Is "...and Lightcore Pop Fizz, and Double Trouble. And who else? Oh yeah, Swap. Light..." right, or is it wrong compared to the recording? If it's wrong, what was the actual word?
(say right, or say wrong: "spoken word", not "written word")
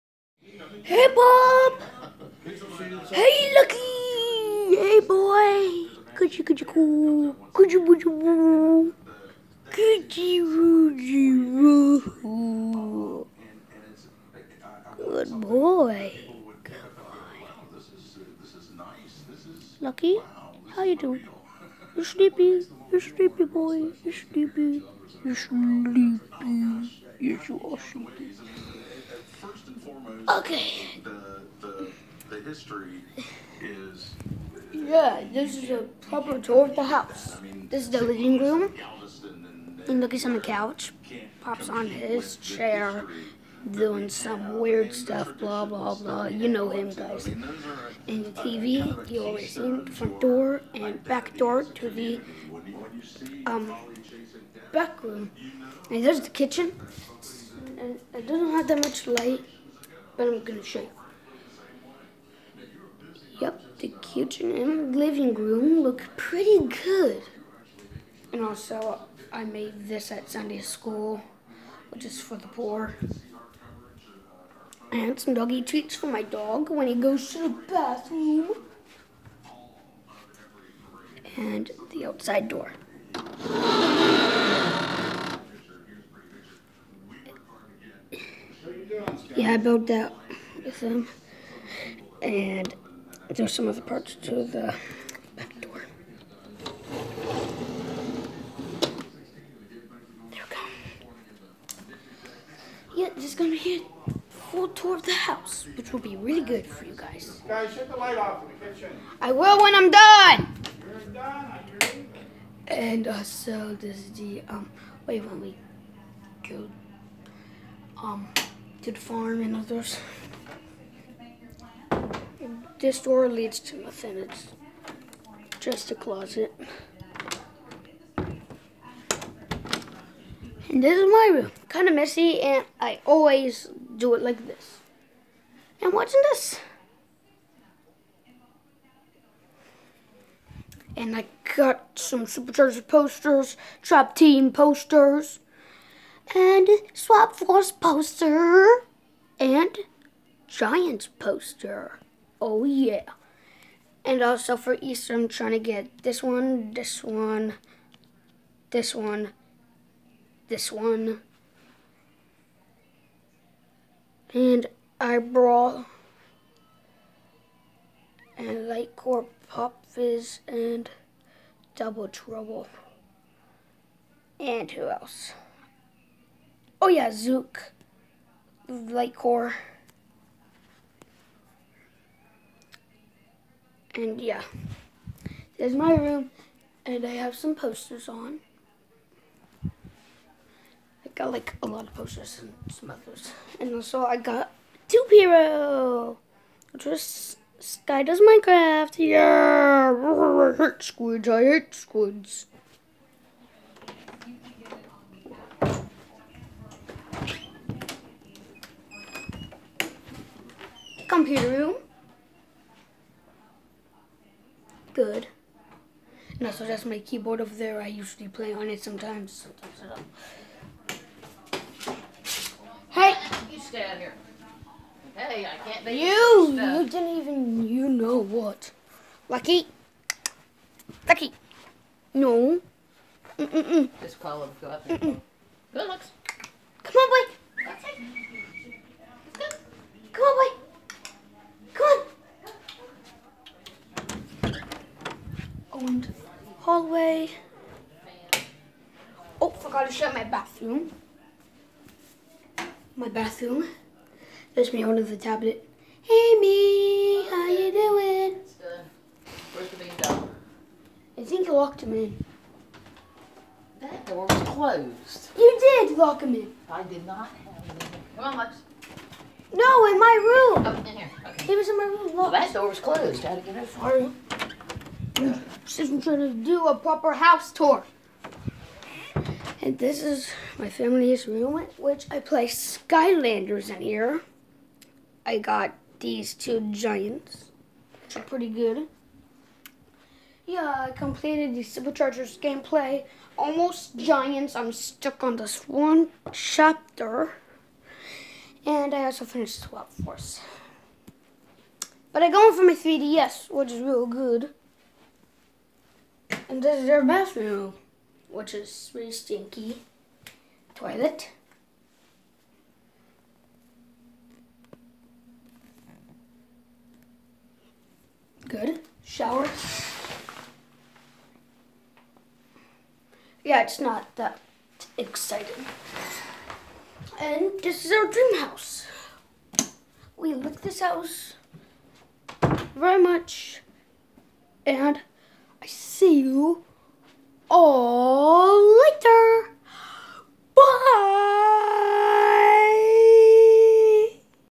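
wrong: "Zook", not "Swap".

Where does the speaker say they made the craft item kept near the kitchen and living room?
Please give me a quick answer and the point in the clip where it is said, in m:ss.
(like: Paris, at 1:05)
Sunday school, at 1:10.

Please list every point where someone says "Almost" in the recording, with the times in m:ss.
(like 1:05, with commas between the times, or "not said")
4:53.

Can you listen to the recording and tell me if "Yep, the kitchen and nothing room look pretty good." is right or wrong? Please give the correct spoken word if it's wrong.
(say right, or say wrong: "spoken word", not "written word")
wrong: "living", not "nothing".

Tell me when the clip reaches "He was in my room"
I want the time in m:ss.
4:31.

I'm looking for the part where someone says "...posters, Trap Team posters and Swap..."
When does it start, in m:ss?
2:22.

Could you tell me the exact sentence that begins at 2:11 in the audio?
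Kind of messy and I always do it like this.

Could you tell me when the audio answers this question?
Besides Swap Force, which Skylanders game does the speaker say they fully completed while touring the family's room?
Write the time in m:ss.
4:51.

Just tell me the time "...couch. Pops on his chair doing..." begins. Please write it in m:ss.
0:40.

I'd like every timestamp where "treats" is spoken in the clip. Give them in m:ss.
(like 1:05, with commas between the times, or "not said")
1:15.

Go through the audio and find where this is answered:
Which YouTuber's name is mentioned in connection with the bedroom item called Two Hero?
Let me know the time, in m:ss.
3:17.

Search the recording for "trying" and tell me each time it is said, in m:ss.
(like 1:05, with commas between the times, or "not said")
2:35, 4:36.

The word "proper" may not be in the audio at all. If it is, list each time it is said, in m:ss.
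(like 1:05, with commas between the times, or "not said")
0:36, 4:36.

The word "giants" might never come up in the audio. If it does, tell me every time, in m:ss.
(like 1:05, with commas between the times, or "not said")
2:30, 4:46, 4:53.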